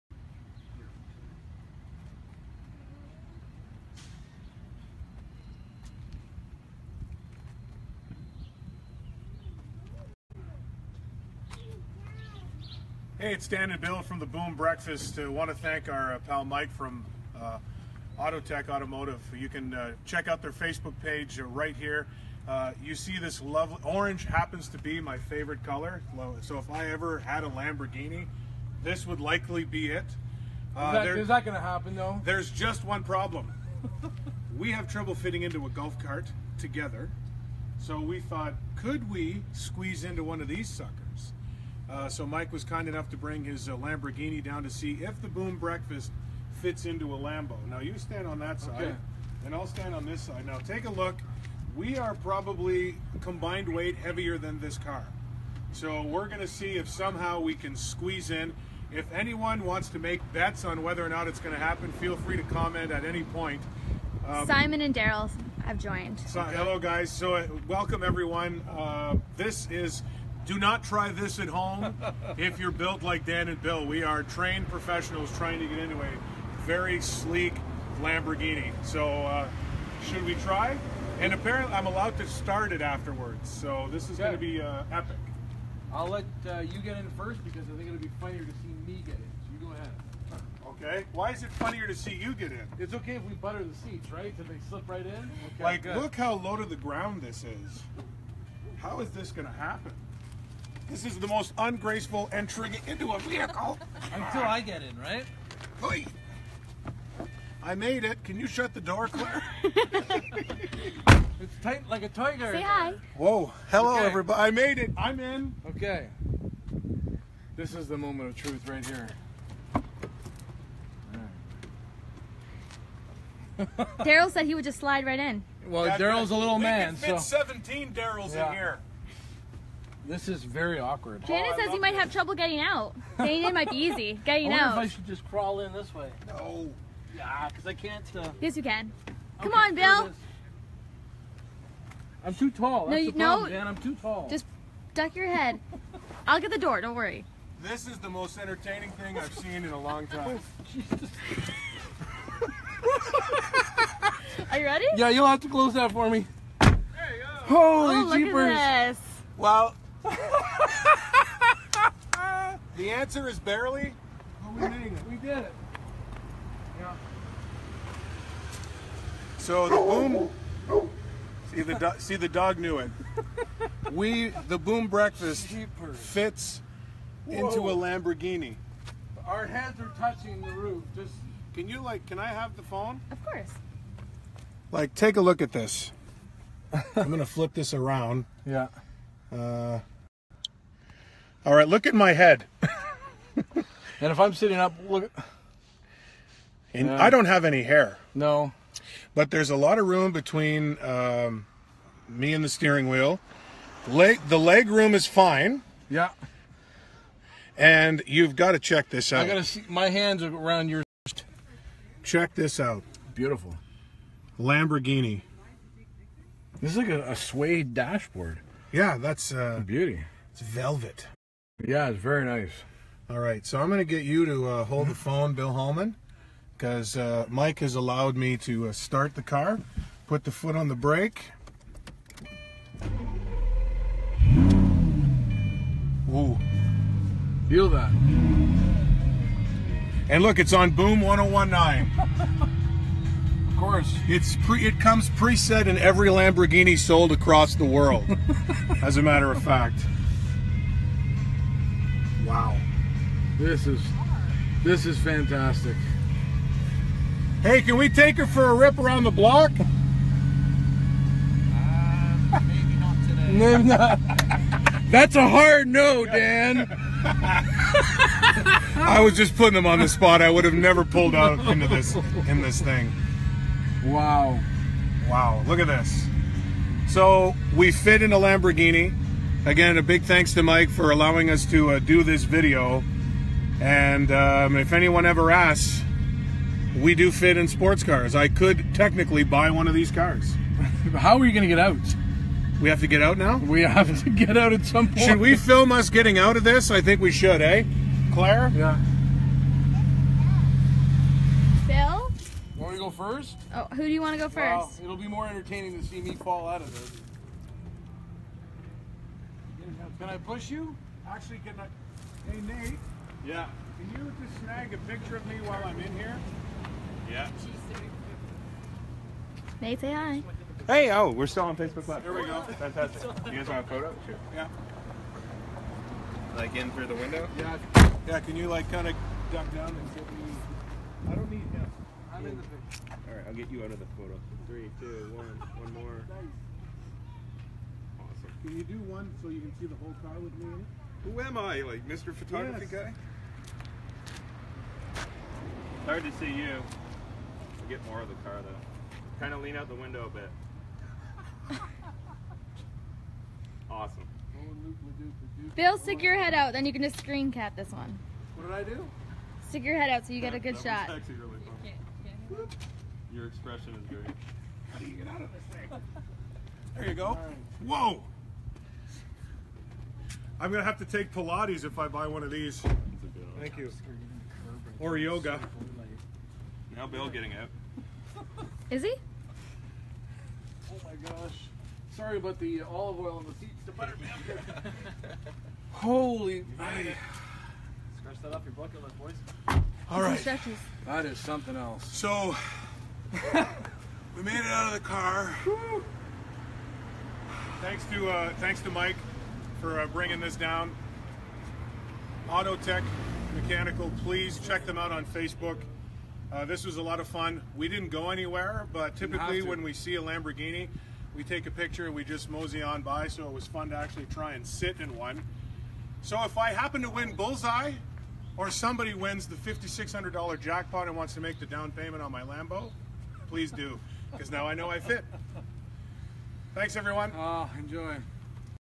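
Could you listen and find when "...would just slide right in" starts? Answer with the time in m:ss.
2:04.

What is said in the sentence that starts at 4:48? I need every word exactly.
I could technically buy one of these cars.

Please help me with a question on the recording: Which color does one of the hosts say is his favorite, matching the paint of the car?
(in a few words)
Orange.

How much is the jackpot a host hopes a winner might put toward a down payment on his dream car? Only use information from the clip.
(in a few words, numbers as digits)
$5,600.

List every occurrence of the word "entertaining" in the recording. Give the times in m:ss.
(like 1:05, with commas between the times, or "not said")
2:28, 5:05.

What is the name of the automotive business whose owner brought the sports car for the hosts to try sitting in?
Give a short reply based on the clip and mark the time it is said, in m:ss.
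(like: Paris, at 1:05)
Autotec Automotive, at 0:18.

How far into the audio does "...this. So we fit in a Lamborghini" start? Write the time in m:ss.
4:35.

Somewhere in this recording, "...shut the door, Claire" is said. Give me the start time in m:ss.
1:48.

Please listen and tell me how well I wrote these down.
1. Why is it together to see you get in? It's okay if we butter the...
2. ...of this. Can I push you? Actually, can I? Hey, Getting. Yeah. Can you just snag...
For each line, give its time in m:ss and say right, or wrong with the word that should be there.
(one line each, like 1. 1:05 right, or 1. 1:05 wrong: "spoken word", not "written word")
1. 1:31 wrong: "funnier", not "together"
2. 5:06 wrong: "Nate", not "Getting".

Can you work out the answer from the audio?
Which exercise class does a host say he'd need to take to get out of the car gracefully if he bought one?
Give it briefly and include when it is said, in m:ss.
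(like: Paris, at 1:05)
Pilates, at 6:11.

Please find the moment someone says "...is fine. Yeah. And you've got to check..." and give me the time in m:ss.
3:24.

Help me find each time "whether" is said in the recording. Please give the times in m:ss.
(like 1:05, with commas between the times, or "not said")
1:00.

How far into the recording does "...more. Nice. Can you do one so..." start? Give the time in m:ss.
5:35.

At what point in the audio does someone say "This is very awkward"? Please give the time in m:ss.
2:10.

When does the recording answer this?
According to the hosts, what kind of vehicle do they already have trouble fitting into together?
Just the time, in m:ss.
0:35.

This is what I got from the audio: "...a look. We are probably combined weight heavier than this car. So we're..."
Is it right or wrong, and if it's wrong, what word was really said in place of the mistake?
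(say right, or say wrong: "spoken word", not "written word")
right.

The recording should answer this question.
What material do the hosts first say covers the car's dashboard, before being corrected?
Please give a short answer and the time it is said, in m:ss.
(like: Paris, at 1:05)
Suede, at 3:37.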